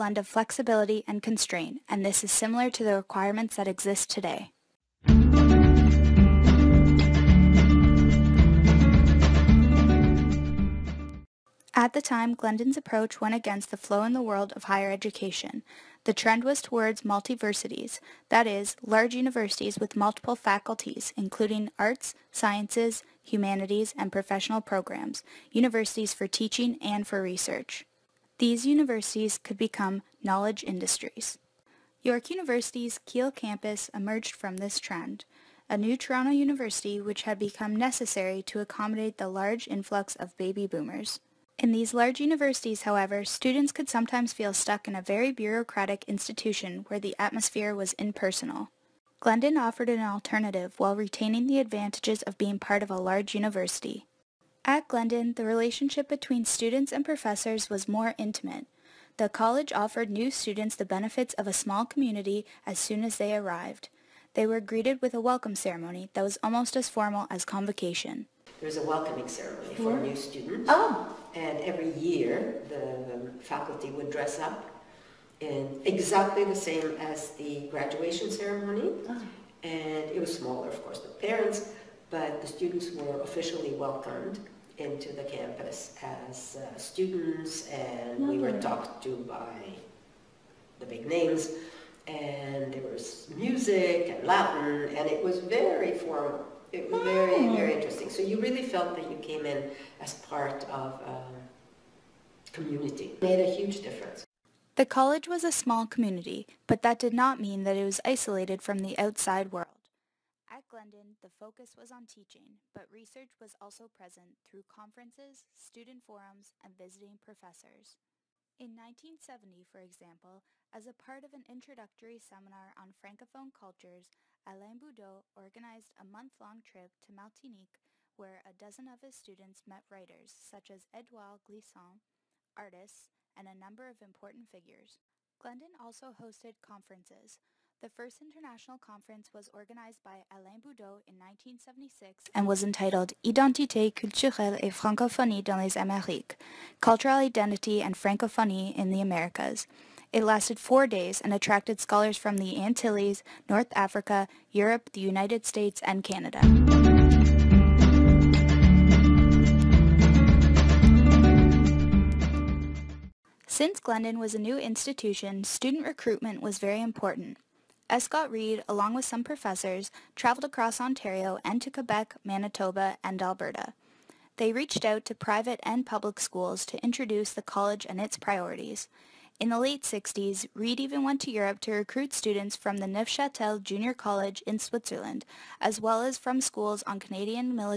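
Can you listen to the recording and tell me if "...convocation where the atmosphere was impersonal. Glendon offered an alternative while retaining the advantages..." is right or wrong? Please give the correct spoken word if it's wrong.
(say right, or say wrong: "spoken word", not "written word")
wrong: "institution", not "convocation".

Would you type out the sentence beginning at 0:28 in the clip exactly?
These universities could become knowledge industries.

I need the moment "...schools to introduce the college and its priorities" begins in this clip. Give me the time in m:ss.
2:56.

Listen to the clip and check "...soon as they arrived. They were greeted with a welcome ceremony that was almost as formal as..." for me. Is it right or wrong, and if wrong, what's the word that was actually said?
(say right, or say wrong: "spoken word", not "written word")
right.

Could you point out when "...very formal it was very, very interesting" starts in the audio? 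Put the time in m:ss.
1:35.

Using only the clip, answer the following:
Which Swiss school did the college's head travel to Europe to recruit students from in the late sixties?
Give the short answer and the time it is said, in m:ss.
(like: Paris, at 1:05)
Neuchâtel Junior College, at 3:02.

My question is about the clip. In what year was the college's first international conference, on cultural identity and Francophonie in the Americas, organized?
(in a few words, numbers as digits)
1976.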